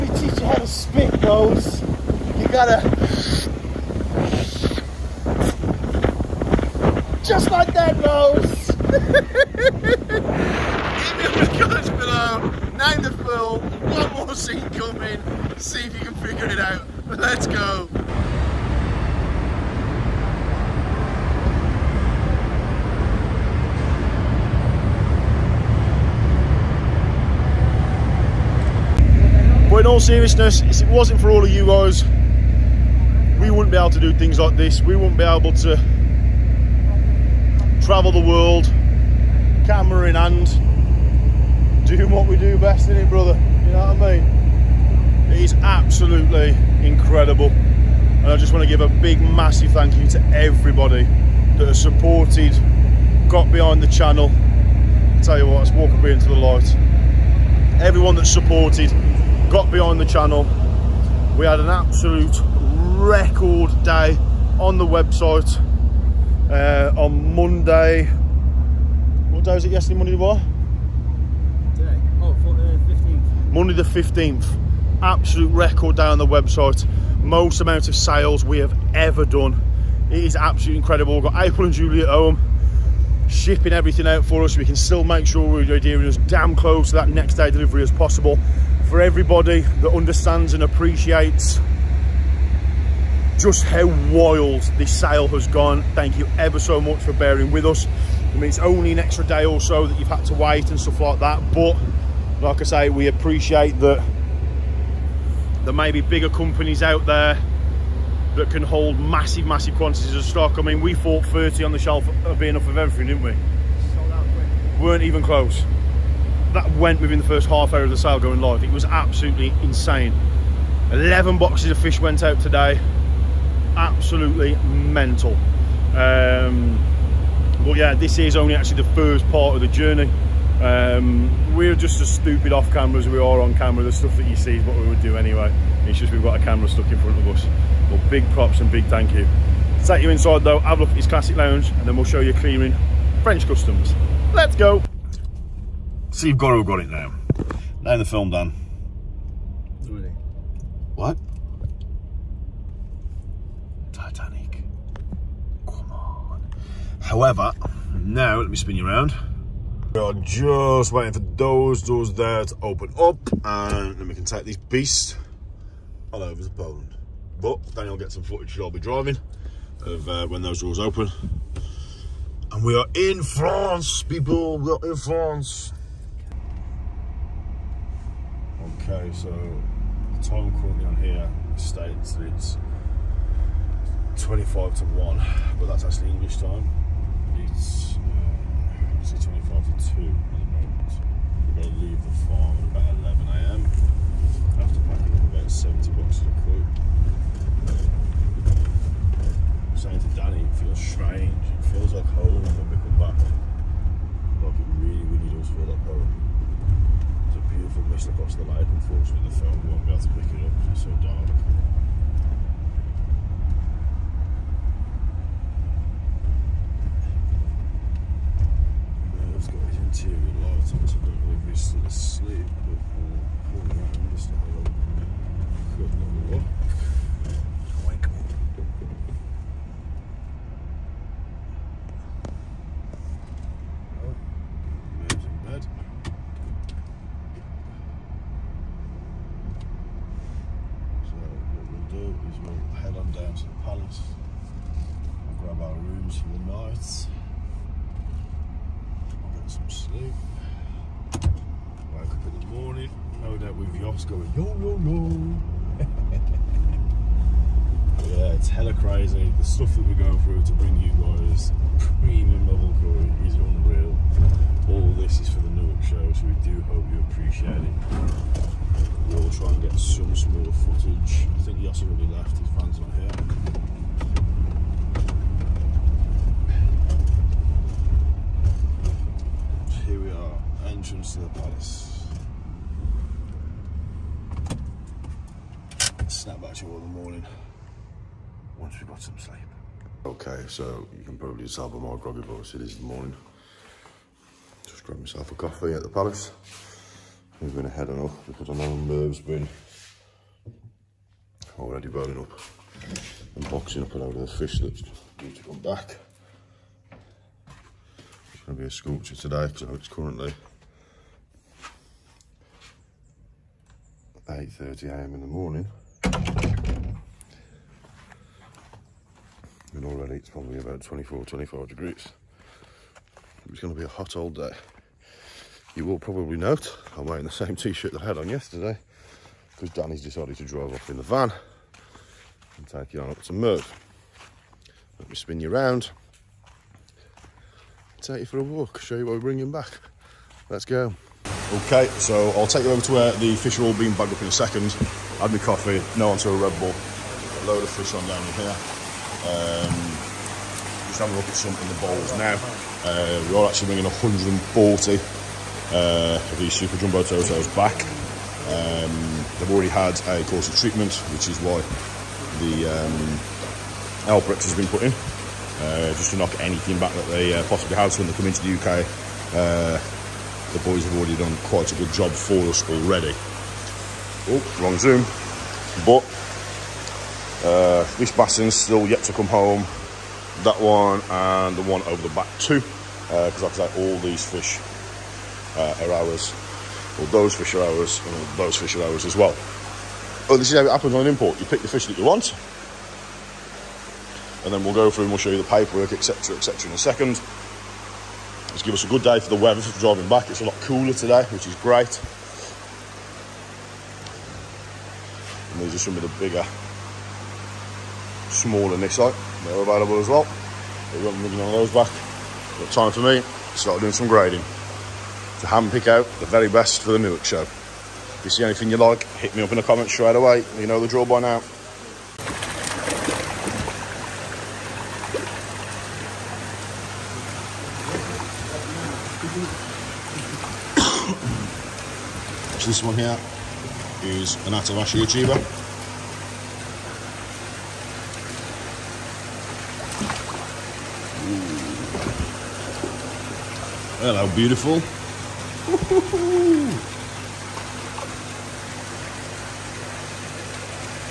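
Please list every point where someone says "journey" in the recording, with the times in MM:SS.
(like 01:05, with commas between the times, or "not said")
02:09.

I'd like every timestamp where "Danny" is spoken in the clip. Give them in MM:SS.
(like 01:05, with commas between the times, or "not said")
03:20, 05:29.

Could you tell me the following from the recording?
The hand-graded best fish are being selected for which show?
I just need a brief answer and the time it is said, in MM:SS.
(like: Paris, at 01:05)
Newark, at 06:56.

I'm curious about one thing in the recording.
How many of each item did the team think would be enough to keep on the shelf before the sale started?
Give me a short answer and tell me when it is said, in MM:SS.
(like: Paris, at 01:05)
30, at 01:51.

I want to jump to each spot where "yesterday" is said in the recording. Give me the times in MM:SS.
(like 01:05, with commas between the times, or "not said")
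01:09, 05:28.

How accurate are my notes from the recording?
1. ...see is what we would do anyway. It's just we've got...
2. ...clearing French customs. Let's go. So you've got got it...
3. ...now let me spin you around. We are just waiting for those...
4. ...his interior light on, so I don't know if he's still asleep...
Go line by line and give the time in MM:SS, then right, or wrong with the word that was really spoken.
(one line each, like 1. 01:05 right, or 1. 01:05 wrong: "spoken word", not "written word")
1. 02:14 right
2. 02:22 right
3. 02:37 right
4. 03:39 right.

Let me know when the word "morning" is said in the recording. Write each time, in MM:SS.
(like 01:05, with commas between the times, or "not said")
04:46, 04:52, 05:15.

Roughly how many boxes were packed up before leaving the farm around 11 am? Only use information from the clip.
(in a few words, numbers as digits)
70.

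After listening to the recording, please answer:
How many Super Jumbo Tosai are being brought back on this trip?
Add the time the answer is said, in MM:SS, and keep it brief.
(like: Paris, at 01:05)
140, at 05:53.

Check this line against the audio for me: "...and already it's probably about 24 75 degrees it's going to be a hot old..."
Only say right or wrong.
wrong.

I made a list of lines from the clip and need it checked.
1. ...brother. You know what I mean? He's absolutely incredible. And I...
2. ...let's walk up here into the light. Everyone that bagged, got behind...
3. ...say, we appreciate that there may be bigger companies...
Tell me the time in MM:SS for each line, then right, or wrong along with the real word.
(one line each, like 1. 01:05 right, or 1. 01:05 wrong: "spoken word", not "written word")
1. 00:43 right
2. 00:55 wrong: "supported", not "bagged"
3. 01:42 right.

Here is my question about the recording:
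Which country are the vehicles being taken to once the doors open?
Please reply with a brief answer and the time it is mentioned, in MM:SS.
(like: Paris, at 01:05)
Poland, at 02:46.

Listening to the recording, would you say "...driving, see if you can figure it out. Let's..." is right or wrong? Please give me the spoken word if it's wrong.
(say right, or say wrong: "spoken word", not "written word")
wrong: "coming", not "driving".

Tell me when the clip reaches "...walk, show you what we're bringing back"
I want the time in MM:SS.
05:38.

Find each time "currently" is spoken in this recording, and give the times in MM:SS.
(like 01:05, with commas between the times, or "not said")
03:00, 05:09.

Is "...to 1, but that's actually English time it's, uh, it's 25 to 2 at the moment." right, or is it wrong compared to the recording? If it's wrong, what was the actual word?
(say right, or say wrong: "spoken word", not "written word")
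right.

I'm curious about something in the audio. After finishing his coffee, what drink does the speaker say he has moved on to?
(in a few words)
Red Bull.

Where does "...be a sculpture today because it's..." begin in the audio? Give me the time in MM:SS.
05:08.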